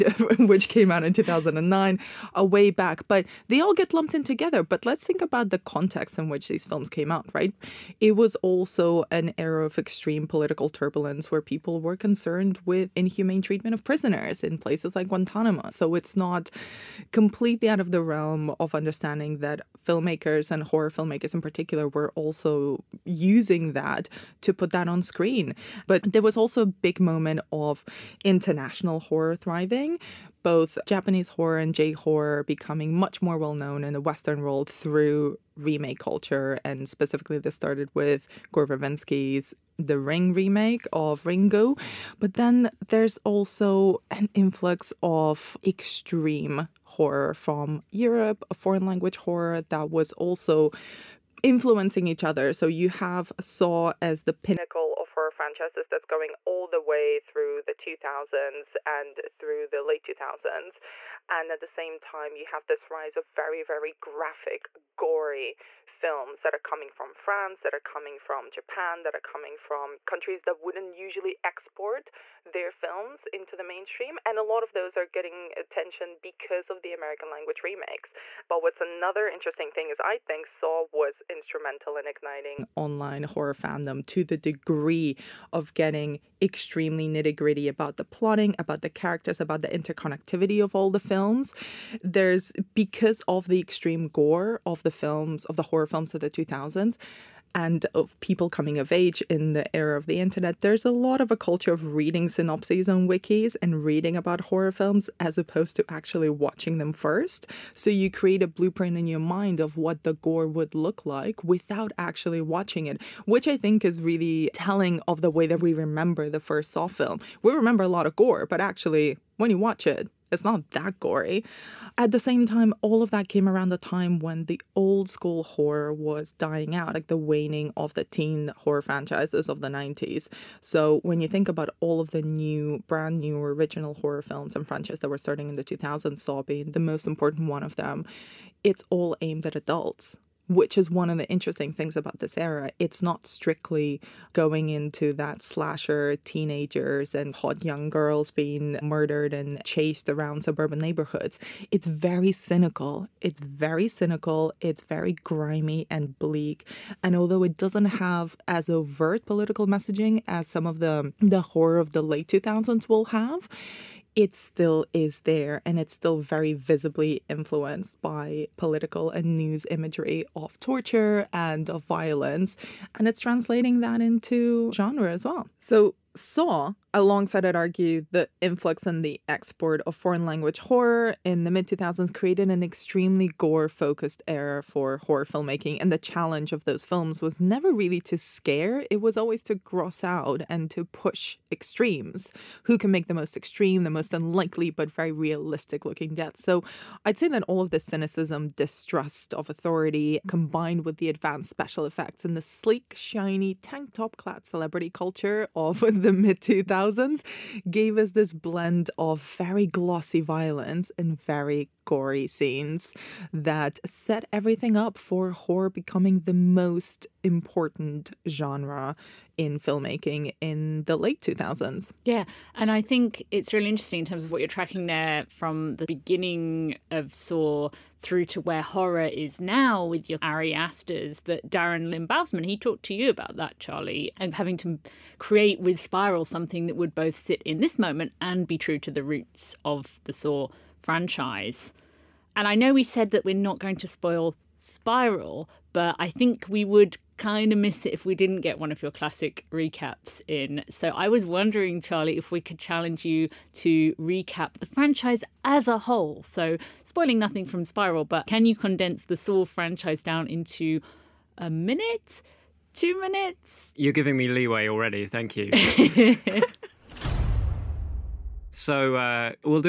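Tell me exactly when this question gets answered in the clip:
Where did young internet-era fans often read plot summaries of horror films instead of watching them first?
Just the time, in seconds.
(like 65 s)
103 s.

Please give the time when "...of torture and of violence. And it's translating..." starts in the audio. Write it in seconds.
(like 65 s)
170 s.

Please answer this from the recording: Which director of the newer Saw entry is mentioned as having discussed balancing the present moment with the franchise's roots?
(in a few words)
Darren Lynn Bousman.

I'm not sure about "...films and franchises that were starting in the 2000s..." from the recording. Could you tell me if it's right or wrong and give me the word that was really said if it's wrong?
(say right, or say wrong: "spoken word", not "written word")
right.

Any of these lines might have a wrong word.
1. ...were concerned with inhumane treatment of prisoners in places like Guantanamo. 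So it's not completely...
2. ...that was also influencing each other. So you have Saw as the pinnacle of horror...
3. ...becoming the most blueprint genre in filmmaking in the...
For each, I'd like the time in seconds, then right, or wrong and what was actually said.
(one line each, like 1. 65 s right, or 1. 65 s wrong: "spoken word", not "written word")
1. 11 s right
2. 49 s right
3. 215 s wrong: "important", not "blueprint".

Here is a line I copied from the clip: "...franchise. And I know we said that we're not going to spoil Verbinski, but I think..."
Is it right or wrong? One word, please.
wrong.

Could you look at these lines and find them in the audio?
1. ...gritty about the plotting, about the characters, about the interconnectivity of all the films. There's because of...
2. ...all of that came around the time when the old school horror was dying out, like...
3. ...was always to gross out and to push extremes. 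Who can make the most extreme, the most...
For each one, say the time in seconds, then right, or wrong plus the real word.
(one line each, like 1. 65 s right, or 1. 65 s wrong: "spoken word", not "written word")
1. 87 s right
2. 122 s right
3. 189 s right.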